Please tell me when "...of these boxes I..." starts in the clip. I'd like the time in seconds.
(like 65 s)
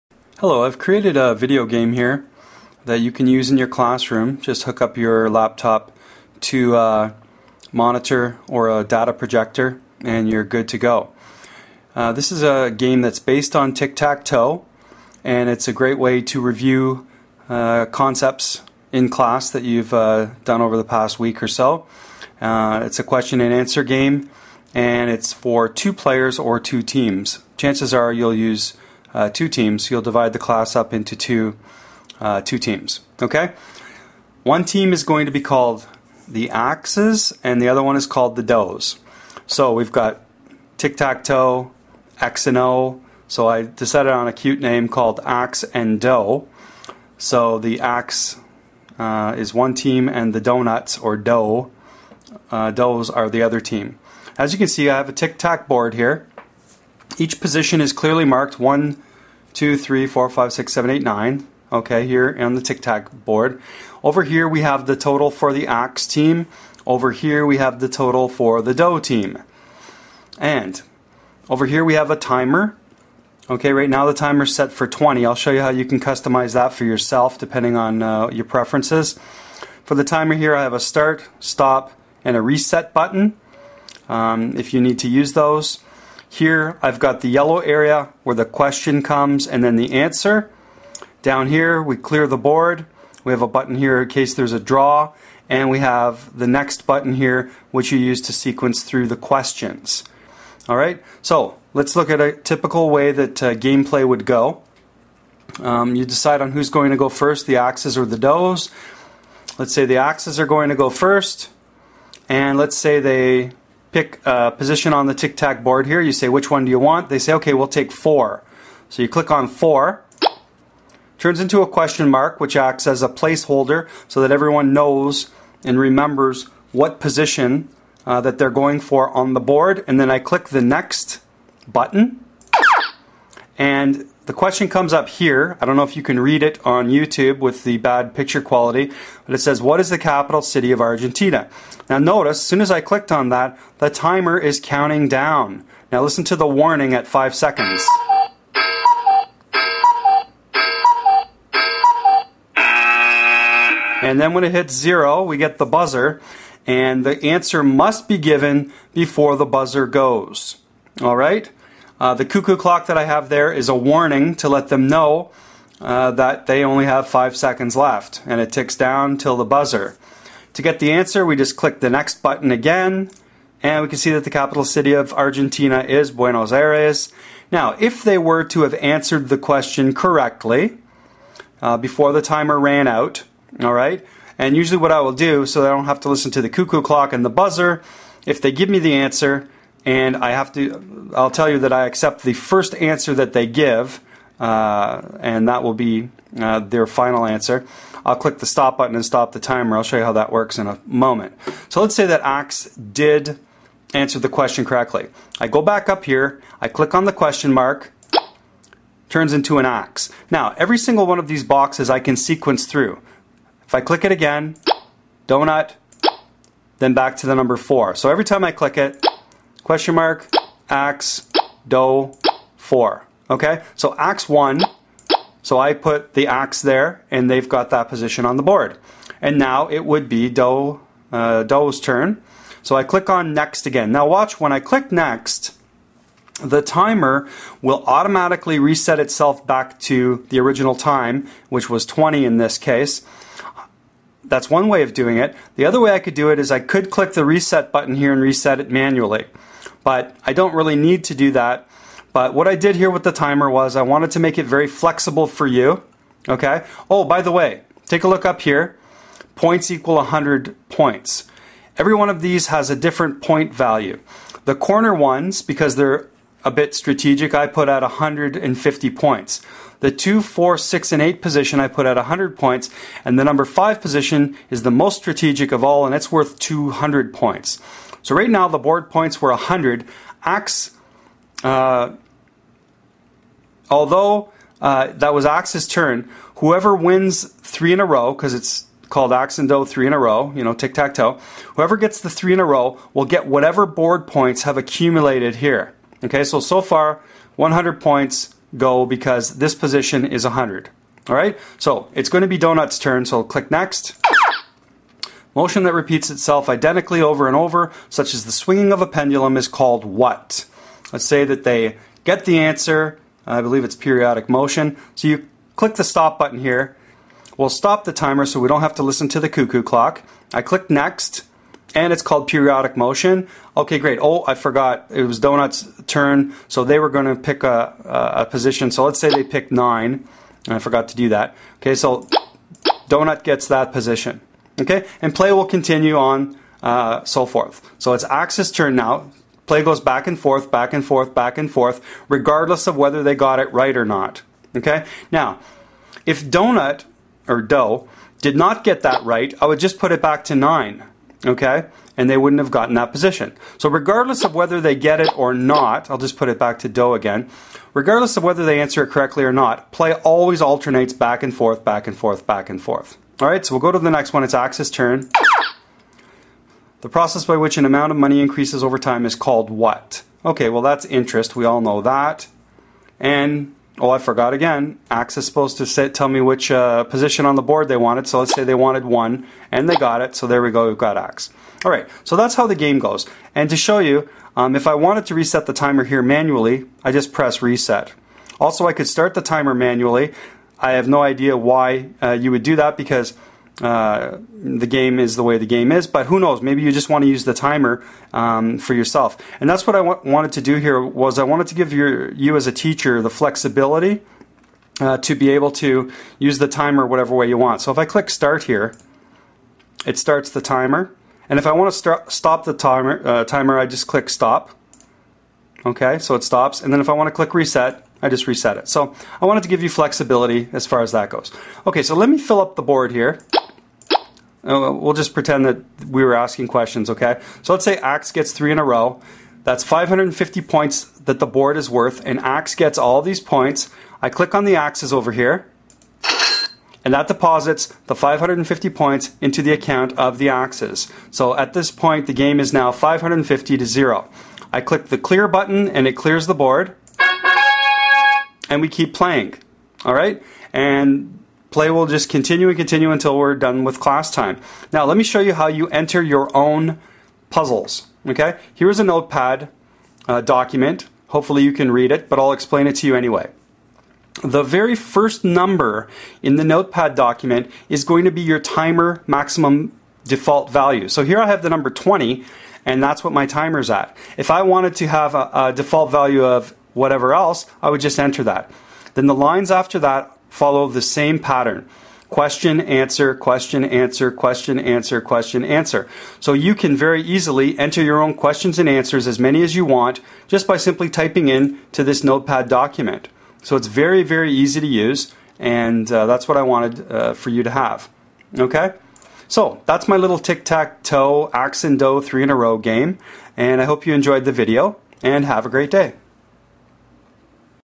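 211 s.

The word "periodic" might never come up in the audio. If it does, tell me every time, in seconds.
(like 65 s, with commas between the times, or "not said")
313 s, 322 s.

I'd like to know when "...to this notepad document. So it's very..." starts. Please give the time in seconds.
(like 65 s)
491 s.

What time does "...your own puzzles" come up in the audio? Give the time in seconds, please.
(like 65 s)
456 s.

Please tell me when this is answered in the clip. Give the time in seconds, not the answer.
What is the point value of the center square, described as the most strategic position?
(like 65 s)
276 s.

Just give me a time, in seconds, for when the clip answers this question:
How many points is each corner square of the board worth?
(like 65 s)
267 s.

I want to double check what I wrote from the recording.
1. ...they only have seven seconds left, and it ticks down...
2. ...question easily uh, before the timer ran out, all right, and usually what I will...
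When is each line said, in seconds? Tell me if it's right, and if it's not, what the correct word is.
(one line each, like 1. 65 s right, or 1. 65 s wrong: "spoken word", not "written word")
1. 166 s wrong: "five", not "seven"
2. 179 s wrong: "correctly", not "easily".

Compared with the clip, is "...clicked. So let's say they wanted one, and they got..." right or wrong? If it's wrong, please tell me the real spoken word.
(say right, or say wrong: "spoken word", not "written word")
wrong: "wanted", not "clicked".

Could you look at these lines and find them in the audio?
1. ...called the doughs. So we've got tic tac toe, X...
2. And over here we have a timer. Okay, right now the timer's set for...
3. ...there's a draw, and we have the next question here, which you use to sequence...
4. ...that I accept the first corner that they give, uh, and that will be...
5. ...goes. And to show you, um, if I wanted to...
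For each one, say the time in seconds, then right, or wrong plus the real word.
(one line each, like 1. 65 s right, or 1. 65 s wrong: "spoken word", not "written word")
1. 38 s right
2. 70 s right
3. 94 s wrong: "button", not "question"
4. 191 s wrong: "answer", not "corner"
5. 382 s right.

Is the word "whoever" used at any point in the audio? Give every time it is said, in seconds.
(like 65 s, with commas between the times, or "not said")
286 s, 291 s.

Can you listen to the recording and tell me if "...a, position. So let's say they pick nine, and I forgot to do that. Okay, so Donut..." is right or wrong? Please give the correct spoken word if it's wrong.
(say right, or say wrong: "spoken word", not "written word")
right.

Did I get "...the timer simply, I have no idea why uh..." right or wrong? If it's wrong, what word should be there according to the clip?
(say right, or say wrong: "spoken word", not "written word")
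wrong: "manually", not "simply".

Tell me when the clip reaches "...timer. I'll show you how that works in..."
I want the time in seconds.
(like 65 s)
199 s.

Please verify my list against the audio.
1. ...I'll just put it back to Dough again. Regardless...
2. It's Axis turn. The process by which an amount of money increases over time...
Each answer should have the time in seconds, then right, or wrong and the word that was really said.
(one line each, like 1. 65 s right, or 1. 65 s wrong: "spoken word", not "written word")
1. 355 s right
2. 364 s right.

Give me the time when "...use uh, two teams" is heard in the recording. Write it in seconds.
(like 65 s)
28 s.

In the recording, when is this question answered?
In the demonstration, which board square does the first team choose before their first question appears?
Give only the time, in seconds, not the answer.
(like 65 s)
117 s.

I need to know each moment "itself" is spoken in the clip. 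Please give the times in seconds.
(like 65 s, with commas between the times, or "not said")
238 s, 306 s.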